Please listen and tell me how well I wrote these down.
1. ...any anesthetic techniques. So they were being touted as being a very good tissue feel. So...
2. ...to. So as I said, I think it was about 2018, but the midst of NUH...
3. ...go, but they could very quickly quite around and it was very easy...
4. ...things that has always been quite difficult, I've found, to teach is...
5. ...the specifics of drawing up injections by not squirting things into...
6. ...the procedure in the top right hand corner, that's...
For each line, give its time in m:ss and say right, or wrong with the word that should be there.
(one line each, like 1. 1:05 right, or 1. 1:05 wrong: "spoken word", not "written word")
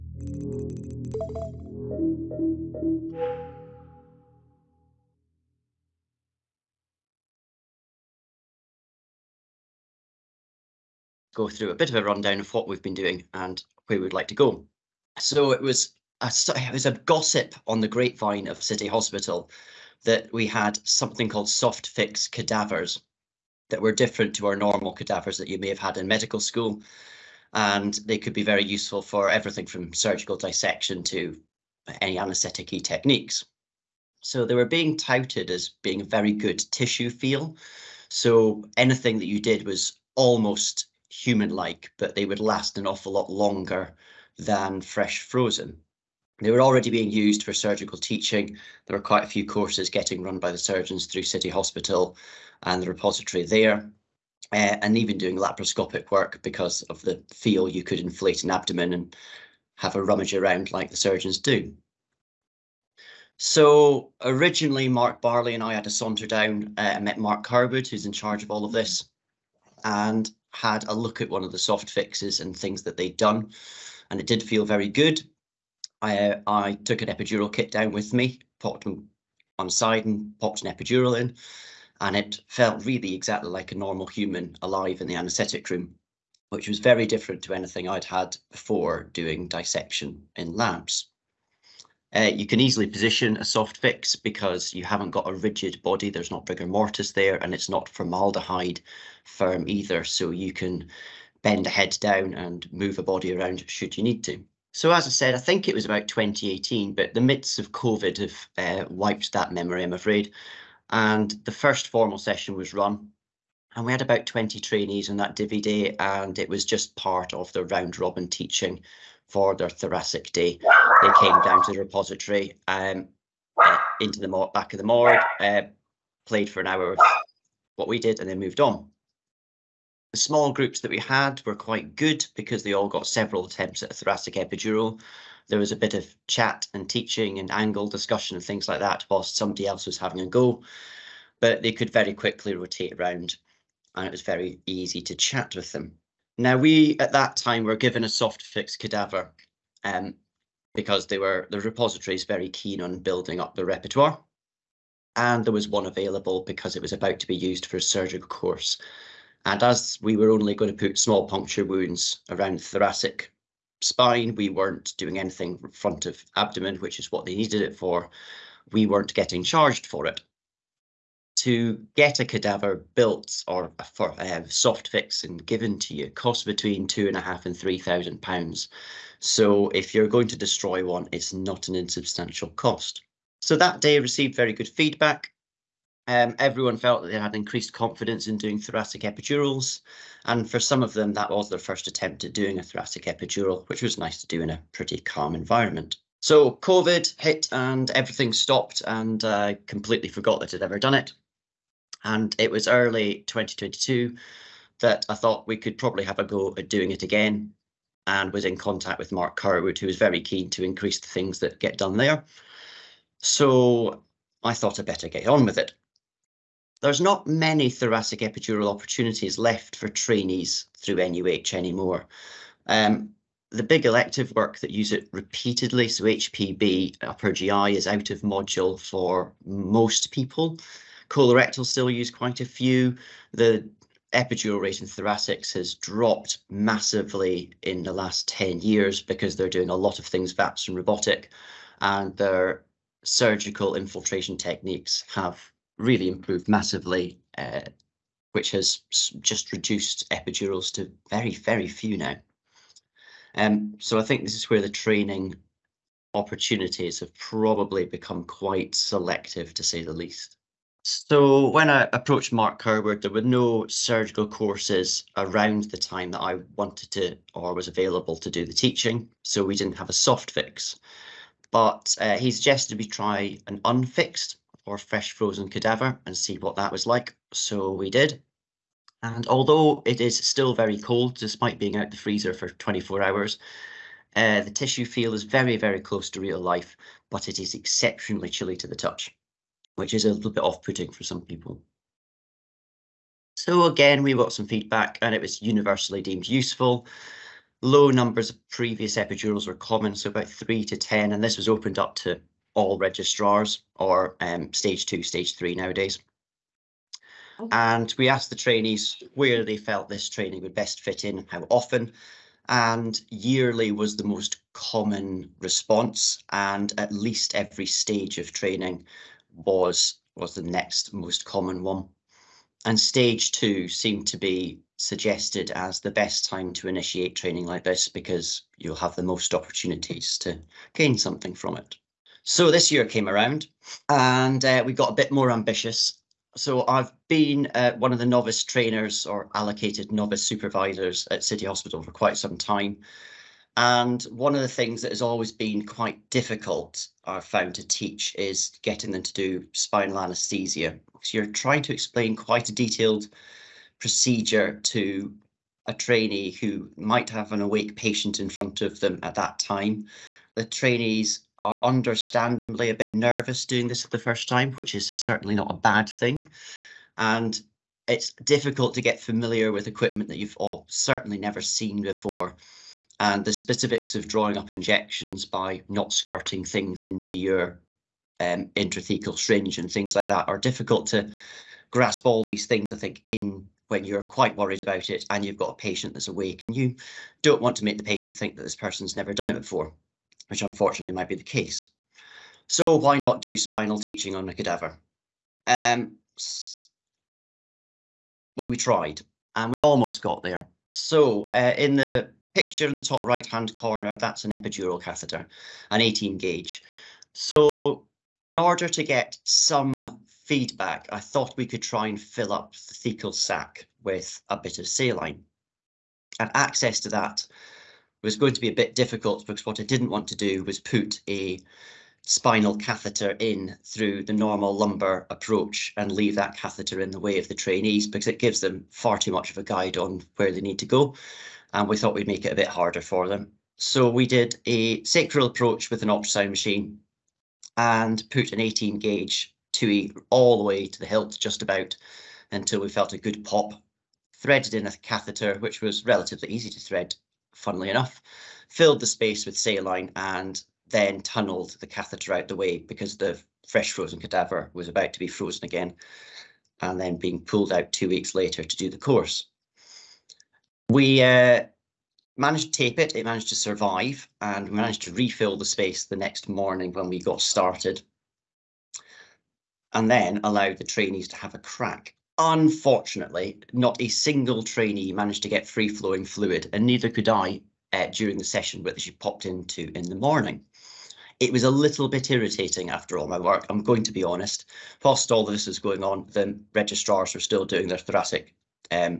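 1. 0:32 right
2. 1:44 wrong: "COVID", not "NUH"
3. 2:20 wrong: "rotate", not "quite"
4. 5:44 right
5. 6:13 right
6. 6:41 wrong: "picture", not "procedure".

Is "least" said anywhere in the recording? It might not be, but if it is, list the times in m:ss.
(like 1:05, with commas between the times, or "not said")
4:19, 5:16.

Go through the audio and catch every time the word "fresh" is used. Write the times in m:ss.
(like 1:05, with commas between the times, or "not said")
0:44, 4:34, 7:33.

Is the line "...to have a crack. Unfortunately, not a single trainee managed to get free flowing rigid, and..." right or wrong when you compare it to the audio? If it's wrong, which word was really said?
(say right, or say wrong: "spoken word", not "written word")
wrong: "fluid", not "rigid".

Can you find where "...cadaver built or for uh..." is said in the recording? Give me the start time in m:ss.
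2:52.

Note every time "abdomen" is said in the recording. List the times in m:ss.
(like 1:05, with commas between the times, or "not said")
0:58, 2:46.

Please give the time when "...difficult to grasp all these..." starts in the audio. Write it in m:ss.
6:20.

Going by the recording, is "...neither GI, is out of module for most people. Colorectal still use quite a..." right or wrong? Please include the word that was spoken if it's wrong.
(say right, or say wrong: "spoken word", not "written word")
wrong: "upper", not "neither".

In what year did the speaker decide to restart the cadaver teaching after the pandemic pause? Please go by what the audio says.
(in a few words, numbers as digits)
2022.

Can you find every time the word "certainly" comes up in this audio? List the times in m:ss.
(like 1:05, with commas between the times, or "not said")
6:04, 6:10.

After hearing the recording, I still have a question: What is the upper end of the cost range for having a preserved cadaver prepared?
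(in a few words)
3,000 pounds.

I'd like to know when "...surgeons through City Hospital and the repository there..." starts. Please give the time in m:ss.
0:50.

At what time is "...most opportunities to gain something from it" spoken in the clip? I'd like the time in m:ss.
5:29.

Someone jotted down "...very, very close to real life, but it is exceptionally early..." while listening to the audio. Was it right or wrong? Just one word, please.
wrong.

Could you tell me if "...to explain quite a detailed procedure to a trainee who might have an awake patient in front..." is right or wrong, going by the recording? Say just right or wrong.
right.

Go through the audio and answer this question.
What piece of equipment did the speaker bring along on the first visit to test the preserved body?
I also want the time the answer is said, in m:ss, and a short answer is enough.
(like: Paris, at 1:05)
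epidural kit, at 1:17.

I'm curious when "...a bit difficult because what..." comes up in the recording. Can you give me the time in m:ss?
6:58.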